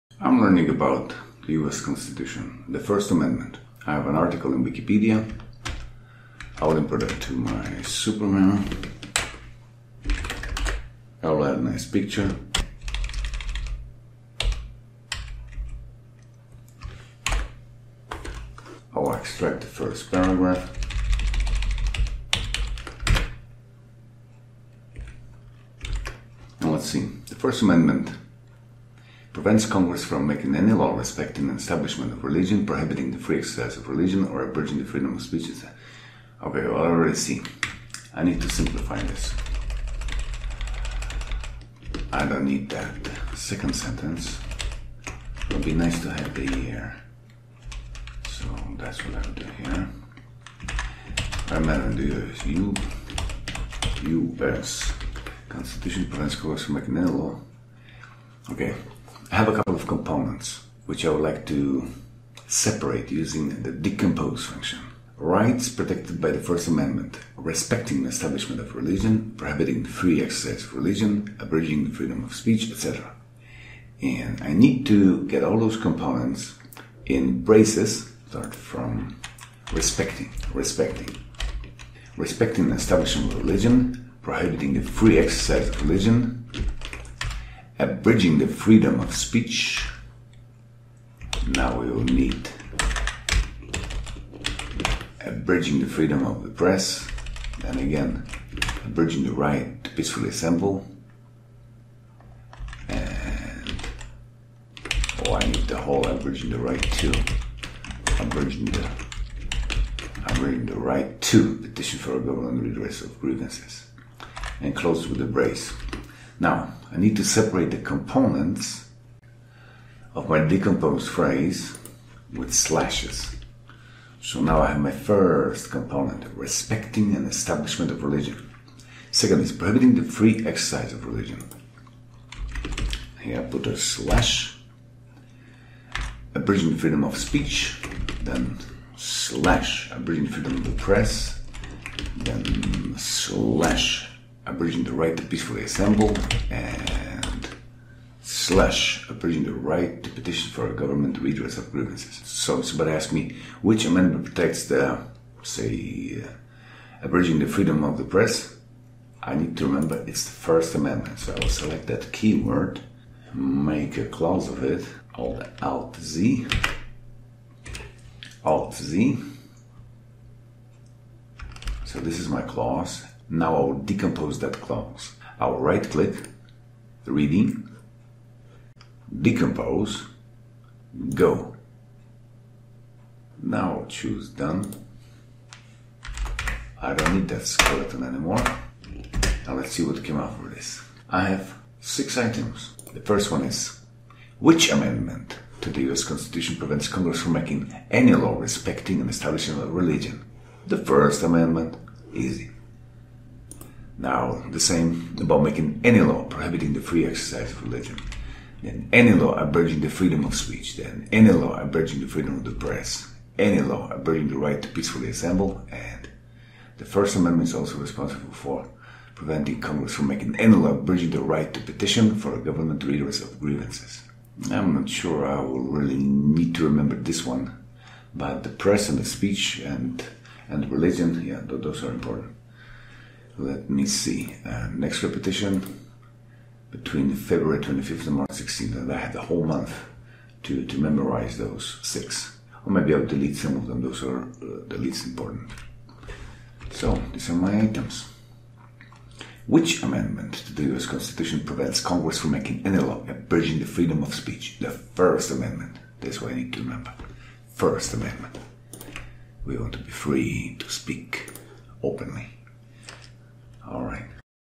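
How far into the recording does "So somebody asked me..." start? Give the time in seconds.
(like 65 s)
152 s.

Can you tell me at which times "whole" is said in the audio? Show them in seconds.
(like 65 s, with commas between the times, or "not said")
105 s, 239 s.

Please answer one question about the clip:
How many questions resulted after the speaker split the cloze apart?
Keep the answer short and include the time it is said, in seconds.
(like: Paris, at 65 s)
6, at 191 s.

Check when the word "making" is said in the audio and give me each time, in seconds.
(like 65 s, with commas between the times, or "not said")
30 s, 56 s, 197 s, 205 s, 220 s, 252 s.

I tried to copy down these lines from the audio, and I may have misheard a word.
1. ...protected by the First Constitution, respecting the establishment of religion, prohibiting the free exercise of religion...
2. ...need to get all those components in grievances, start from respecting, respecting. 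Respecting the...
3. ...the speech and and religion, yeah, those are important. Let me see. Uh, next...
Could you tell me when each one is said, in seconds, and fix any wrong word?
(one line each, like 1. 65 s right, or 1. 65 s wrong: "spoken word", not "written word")
1. 65 s wrong: "Amendment", not "Constitution"
2. 74 s wrong: "braces", not "grievances"
3. 228 s right.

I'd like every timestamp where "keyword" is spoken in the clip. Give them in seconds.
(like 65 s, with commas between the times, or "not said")
162 s.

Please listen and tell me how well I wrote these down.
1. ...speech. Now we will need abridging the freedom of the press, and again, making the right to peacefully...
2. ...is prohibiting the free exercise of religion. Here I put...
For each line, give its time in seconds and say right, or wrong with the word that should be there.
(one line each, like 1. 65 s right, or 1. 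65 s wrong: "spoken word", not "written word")
1. 89 s wrong: "abridging", not "making"
2. 129 s right.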